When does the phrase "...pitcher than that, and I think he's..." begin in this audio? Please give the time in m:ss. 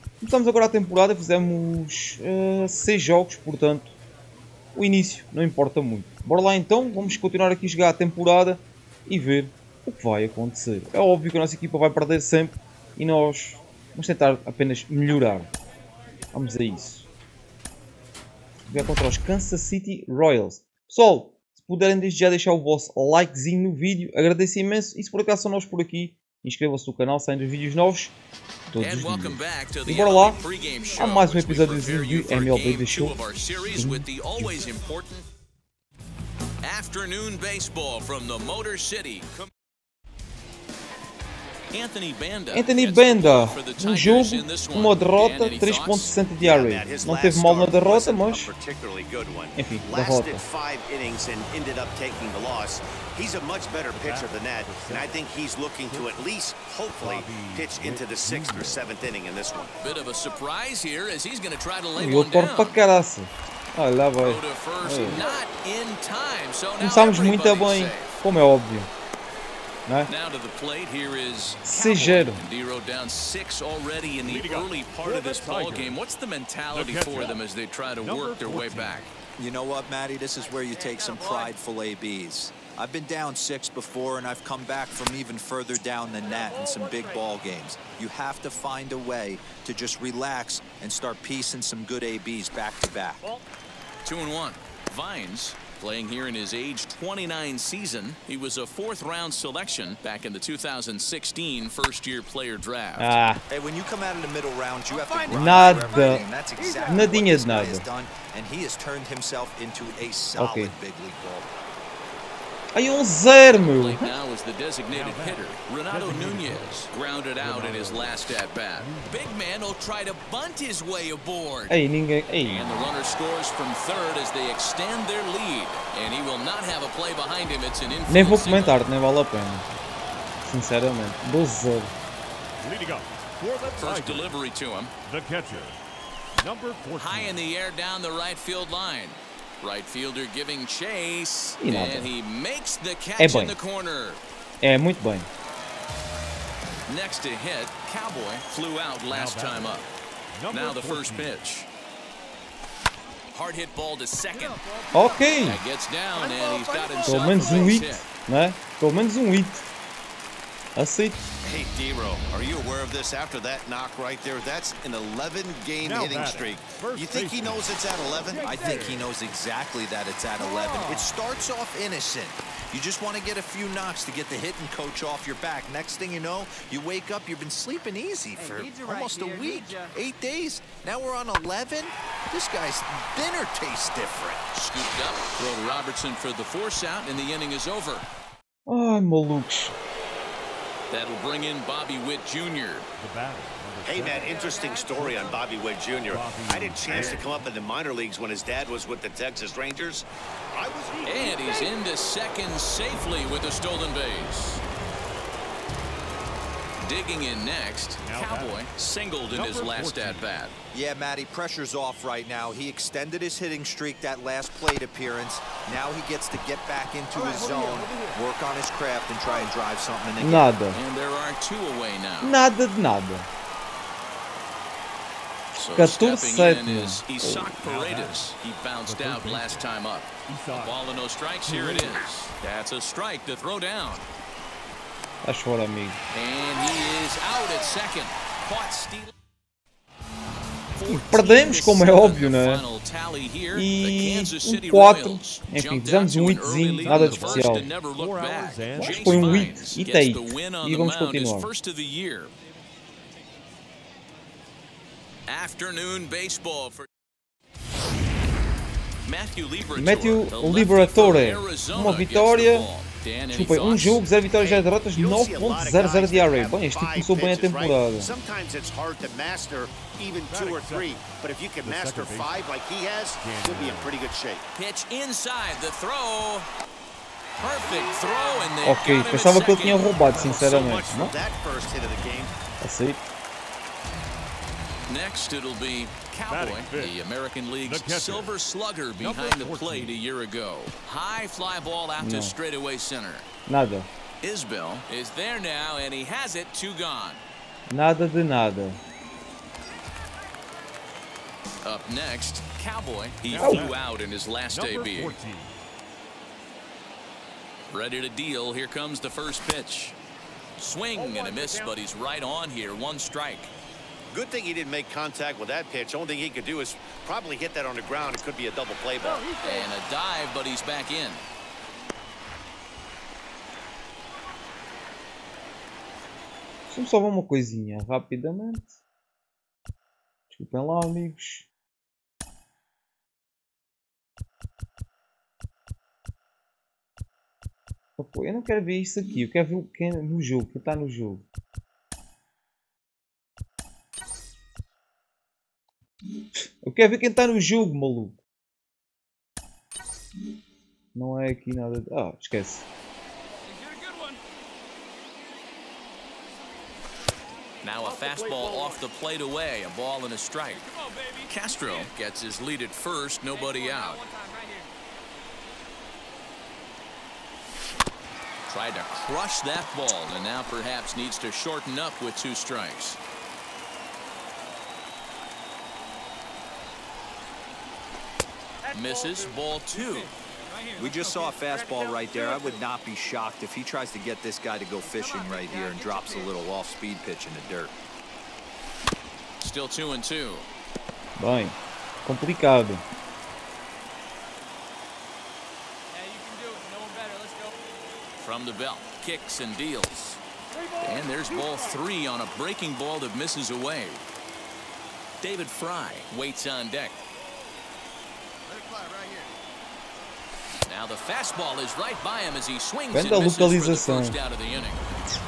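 0:54.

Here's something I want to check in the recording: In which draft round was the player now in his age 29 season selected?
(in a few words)
Fourth round.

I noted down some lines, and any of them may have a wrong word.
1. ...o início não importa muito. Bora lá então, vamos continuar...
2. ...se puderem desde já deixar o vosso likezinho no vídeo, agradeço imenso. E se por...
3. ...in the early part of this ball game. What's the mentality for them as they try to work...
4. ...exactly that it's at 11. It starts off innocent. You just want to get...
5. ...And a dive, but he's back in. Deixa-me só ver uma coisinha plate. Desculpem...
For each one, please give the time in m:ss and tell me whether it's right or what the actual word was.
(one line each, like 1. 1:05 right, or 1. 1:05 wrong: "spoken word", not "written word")
1. 0:04 right
2. 0:21 right
3. 1:14 right
4. 2:49 right
5. 5:19 wrong: "rapidamente", not "plate".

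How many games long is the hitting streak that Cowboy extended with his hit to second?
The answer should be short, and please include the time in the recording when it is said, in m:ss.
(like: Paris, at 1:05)
11, at 2:44.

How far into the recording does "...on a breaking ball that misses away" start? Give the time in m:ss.
6:42.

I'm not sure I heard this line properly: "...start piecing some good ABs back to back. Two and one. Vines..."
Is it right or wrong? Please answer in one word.
right.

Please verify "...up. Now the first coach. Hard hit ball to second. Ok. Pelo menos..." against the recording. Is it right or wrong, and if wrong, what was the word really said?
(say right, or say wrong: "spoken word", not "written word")
wrong: "pitch", not "coach".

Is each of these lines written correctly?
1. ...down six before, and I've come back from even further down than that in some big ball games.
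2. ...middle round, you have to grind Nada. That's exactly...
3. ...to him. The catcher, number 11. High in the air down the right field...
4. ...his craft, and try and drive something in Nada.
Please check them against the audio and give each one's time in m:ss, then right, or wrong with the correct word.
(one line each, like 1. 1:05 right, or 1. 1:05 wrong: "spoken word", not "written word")
1. 1:23 right
2. 1:44 right
3. 2:14 wrong: "14", not "11"
4. 3:38 right.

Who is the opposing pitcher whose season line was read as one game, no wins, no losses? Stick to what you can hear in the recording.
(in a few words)
Matthew Liberatore.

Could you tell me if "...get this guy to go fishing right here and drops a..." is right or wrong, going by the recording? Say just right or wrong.
right.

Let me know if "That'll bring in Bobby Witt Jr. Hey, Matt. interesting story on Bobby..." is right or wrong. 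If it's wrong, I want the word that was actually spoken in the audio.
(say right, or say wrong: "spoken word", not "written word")
right.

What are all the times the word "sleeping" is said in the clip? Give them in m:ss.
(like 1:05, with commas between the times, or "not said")
2:57.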